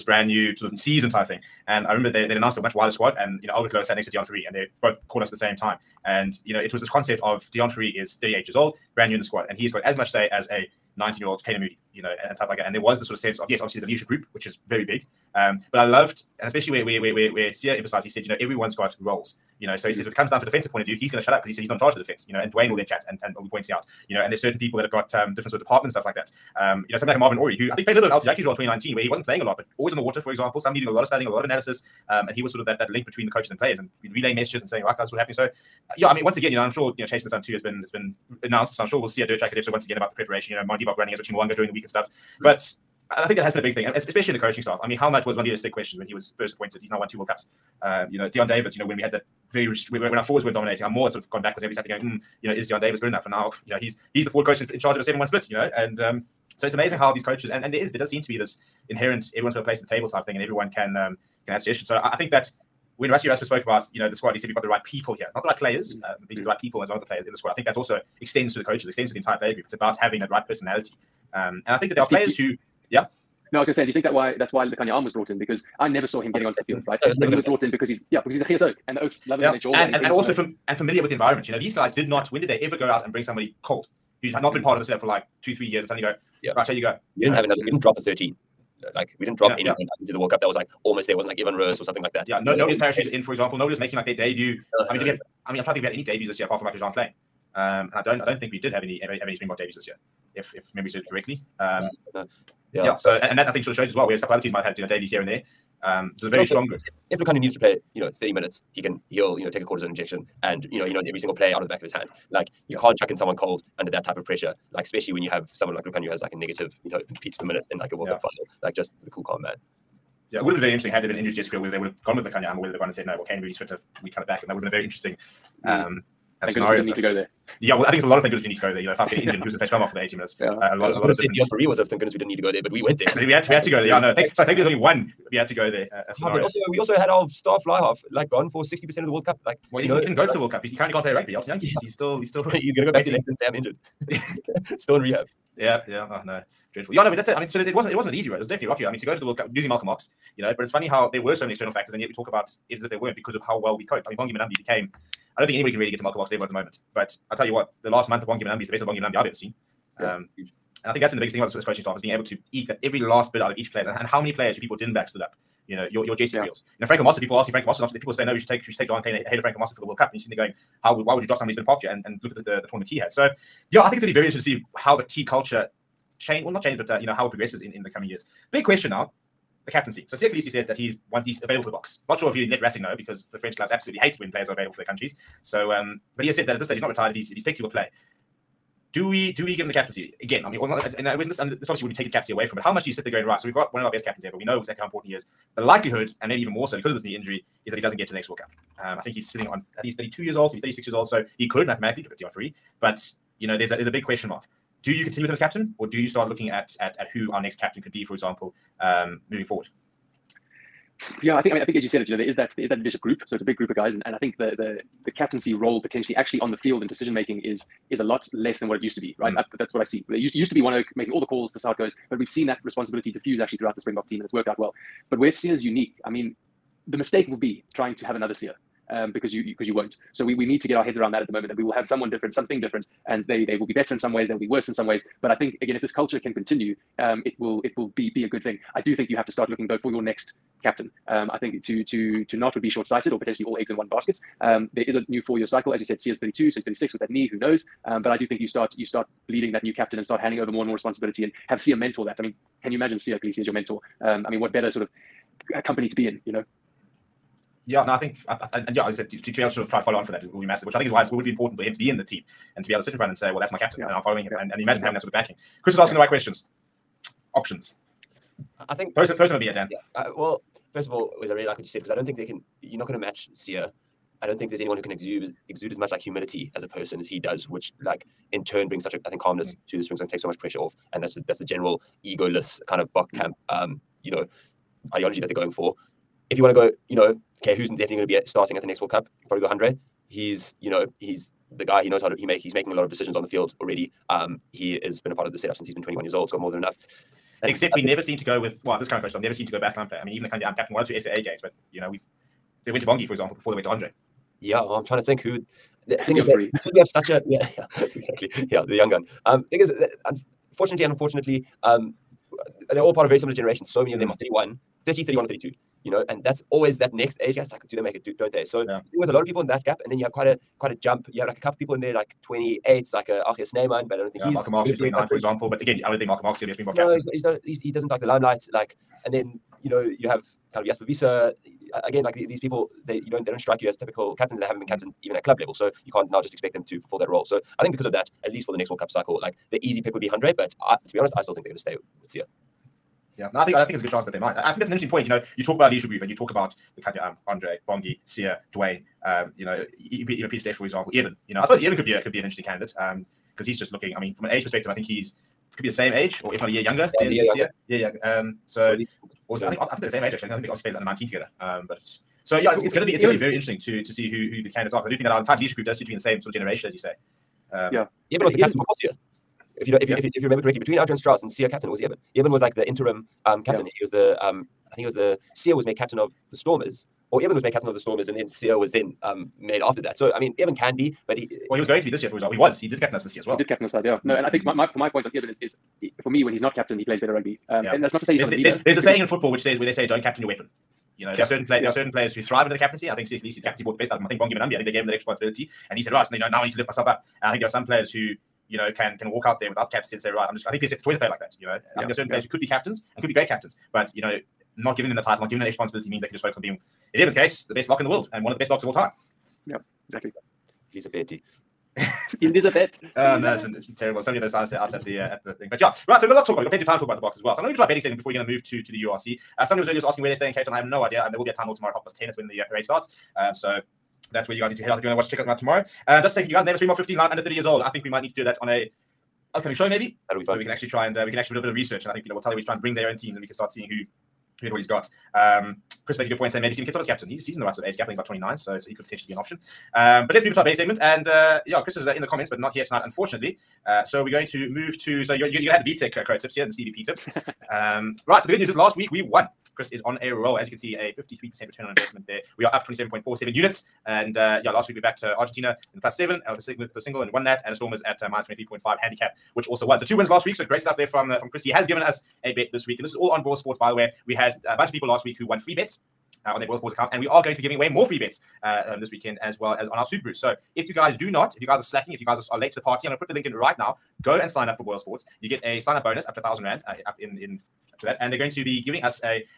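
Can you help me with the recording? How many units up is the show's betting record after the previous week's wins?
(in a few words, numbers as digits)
27.47.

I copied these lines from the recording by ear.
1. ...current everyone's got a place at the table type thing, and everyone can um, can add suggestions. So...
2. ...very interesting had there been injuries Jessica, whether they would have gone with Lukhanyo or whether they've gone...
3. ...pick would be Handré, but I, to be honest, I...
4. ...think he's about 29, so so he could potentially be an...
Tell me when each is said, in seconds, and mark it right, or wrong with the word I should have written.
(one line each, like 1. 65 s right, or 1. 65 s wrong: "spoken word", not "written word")
1. 58 s wrong: "inherent", not "current"
2. 120 s right
3. 339 s right
4. 437 s right.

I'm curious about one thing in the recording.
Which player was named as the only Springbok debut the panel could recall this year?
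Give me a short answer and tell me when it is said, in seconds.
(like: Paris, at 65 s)
Jean Kleyn, at 96 s.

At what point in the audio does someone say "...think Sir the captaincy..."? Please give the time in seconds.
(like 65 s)
392 s.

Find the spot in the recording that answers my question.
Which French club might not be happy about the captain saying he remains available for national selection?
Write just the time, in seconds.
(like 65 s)
182 s.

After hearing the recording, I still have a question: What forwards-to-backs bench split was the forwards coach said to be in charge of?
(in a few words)
7-1.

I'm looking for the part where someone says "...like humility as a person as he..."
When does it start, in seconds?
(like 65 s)
275 s.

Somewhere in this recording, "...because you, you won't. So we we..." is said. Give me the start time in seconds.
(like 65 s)
229 s.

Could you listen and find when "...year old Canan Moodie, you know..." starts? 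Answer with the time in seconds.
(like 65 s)
11 s.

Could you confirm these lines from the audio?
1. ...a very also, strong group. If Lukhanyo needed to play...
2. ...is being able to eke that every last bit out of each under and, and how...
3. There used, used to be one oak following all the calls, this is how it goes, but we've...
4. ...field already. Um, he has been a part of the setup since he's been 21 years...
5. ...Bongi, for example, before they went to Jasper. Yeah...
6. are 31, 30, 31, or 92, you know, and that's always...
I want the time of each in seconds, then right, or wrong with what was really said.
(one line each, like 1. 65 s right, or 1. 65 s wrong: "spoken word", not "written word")
1. 106 s right
2. 161 s wrong: "player", not "under"
3. 220 s wrong: "making", not "following"
4. 293 s right
5. 302 s wrong: "Handré", not "Jasper"
6. 314 s wrong: "32", not "92".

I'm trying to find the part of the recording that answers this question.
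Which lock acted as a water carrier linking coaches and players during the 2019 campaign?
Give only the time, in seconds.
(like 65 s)
27 s.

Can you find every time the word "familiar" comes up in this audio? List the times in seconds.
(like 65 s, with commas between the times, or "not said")
80 s.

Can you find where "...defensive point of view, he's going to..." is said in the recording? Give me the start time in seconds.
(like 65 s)
20 s.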